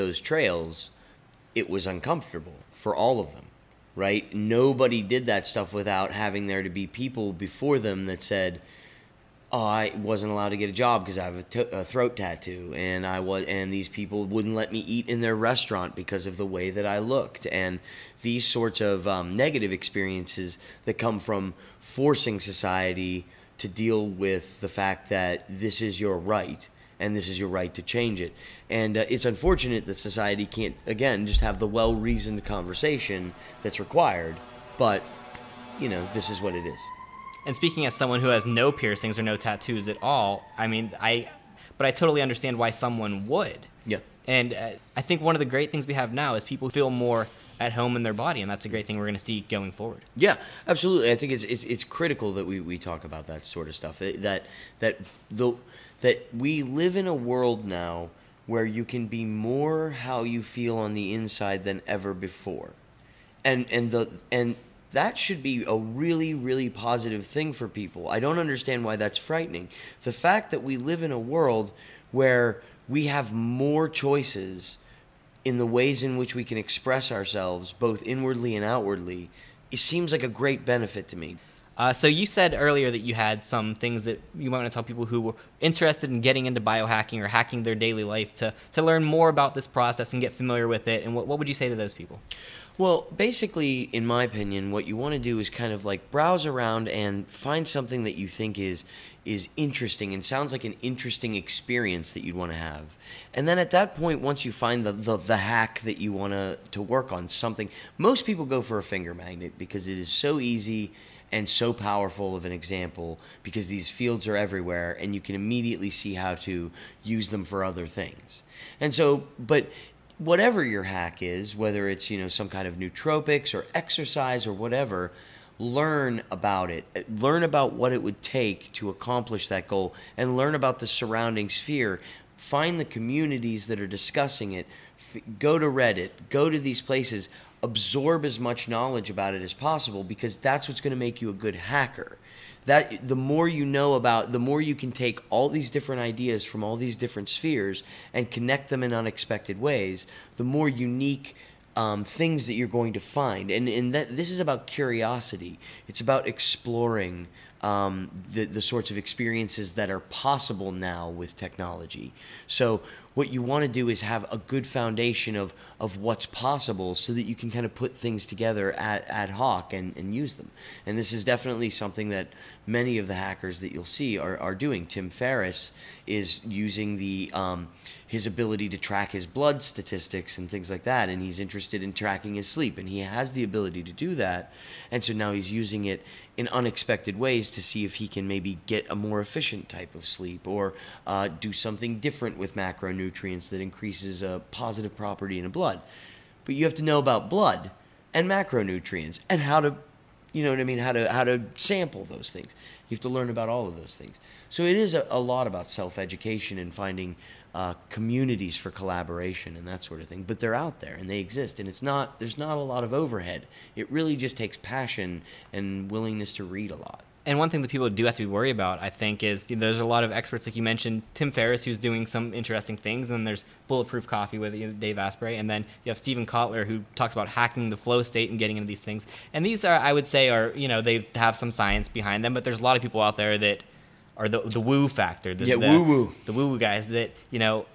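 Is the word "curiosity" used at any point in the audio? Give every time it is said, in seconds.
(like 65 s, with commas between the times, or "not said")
154 s.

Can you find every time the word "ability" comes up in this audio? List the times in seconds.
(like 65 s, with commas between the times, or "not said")
178 s, 183 s.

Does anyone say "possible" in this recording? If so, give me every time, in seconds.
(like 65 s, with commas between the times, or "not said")
139 s, 159 s, 166 s.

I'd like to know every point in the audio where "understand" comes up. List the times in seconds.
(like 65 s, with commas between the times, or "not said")
42 s, 68 s.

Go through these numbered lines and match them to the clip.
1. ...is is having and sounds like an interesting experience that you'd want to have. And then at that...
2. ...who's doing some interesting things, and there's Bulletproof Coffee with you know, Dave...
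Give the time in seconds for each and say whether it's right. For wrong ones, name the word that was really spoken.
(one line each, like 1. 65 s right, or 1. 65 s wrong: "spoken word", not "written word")
1. 98 s wrong: "interesting", not "having"
2. 221 s right.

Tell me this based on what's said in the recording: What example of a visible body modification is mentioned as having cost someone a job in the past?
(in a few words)
Throat tattoo.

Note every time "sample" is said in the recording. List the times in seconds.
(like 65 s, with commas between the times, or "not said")
201 s.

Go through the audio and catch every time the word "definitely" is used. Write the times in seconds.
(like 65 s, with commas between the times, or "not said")
171 s.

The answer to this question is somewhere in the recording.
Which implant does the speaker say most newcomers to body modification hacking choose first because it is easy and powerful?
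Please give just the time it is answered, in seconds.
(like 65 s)
108 s.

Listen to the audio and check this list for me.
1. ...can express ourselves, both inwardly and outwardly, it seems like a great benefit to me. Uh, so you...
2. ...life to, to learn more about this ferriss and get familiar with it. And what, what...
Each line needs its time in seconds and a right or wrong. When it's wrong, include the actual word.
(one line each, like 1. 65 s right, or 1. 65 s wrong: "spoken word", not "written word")
1. 76 s right
2. 88 s wrong: "process", not "ferriss".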